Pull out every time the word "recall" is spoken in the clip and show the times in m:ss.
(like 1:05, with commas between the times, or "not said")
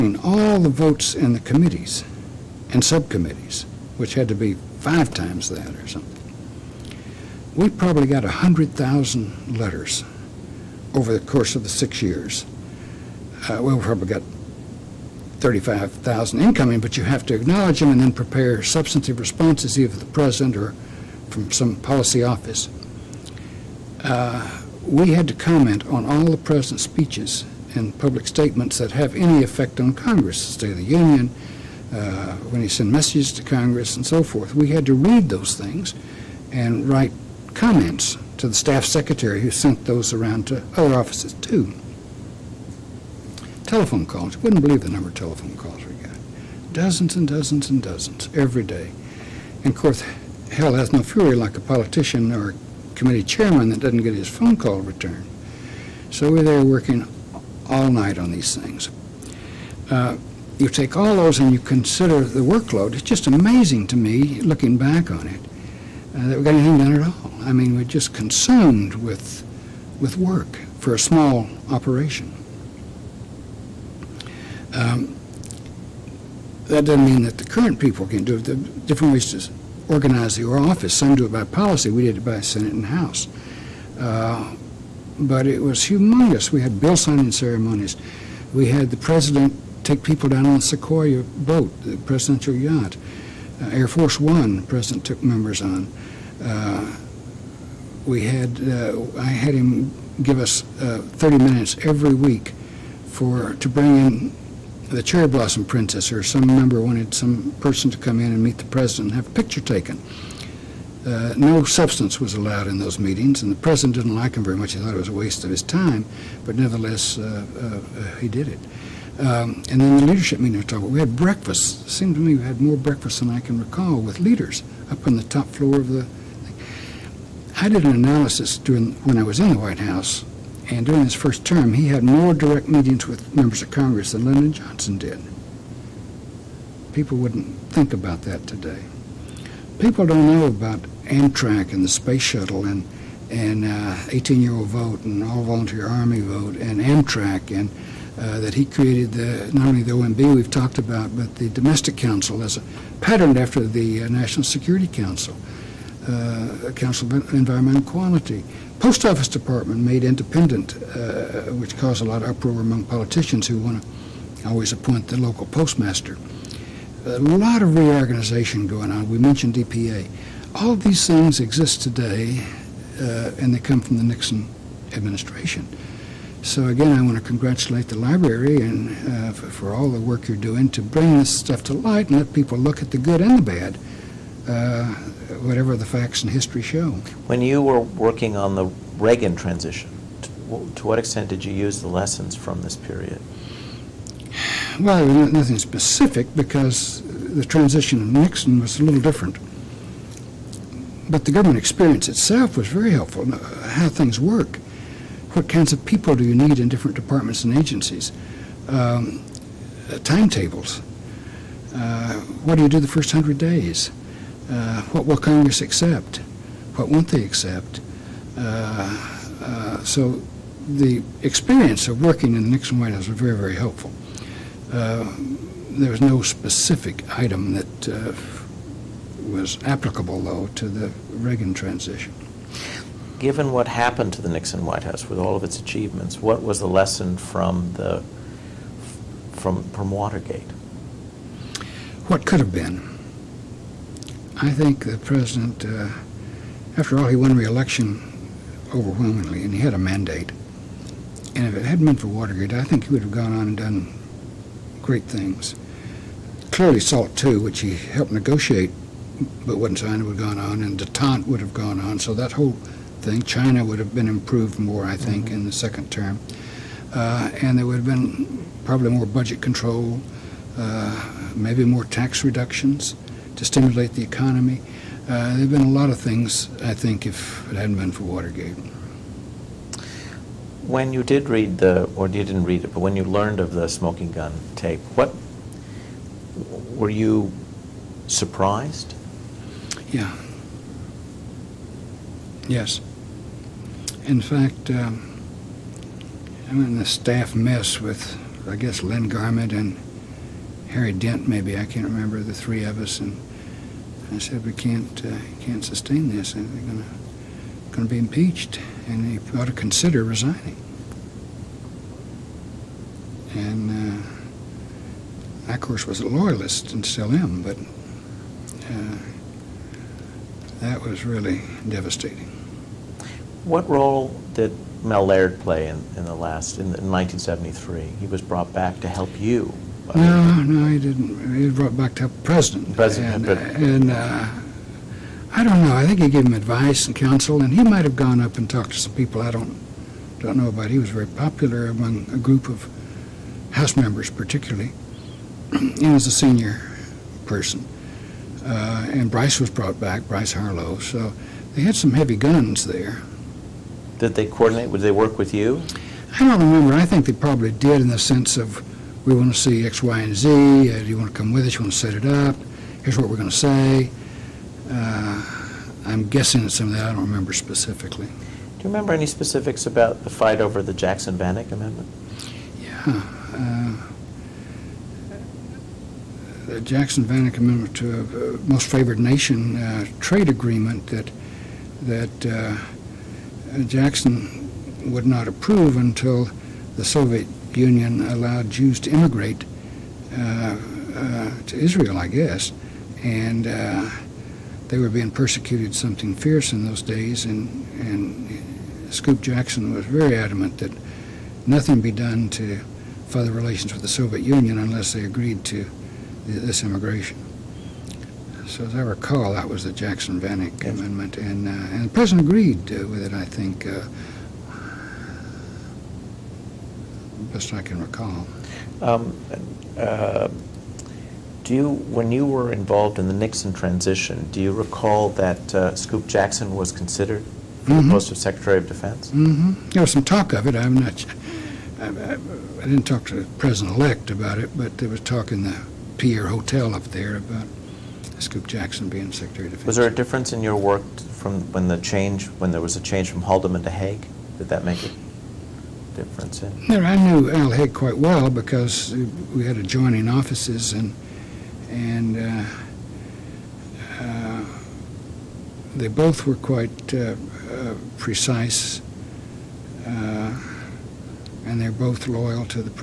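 2:03, 6:48, 6:57, 7:04.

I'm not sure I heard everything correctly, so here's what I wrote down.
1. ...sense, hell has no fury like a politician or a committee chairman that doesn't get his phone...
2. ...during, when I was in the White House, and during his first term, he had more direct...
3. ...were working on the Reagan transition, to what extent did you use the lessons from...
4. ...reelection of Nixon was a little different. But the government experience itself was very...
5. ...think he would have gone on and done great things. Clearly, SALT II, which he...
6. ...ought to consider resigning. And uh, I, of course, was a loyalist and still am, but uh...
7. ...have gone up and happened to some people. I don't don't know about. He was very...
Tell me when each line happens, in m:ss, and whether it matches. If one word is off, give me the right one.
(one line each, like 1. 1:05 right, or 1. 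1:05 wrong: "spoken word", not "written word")
1. 0:49 wrong: "course", not "sense"
2. 2:08 right
3. 3:07 right
4. 3:17 wrong: "transition", not "reelection"
5. 4:12 right
6. 5:09 right
7. 5:37 wrong: "talked", not "happened".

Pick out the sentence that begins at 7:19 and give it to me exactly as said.
Was there a difference in your work from when the change, when there was a change from Haldeman to Haig?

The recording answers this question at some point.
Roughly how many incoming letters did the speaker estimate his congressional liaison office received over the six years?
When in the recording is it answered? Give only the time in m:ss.
0:15.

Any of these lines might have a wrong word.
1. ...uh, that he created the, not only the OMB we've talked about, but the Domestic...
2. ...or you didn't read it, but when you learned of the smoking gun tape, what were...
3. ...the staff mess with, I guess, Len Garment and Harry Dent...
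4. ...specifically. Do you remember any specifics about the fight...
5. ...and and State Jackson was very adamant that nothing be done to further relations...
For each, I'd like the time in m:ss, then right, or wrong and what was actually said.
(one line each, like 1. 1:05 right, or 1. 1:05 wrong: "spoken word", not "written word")
1. 2:28 right
2. 4:41 right
3. 4:56 right
4. 6:07 right
5. 6:37 wrong: "Scoop", not "State".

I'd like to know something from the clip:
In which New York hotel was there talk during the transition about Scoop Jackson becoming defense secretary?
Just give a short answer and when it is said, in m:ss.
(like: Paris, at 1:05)
Pierre hotel, at 7:15.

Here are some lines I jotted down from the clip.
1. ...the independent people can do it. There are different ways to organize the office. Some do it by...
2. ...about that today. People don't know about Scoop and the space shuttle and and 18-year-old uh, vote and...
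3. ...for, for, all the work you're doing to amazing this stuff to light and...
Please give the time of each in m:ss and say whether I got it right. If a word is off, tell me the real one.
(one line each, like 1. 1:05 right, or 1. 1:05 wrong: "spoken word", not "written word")
1. 1:17 wrong: "current", not "independent"
2. 2:17 wrong: "Amtrak", not "Scoop"
3. 2:59 wrong: "bring", not "amazing".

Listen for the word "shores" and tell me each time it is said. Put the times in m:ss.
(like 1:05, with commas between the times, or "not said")
not said.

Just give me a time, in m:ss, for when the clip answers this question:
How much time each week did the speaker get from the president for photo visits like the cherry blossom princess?
1:41.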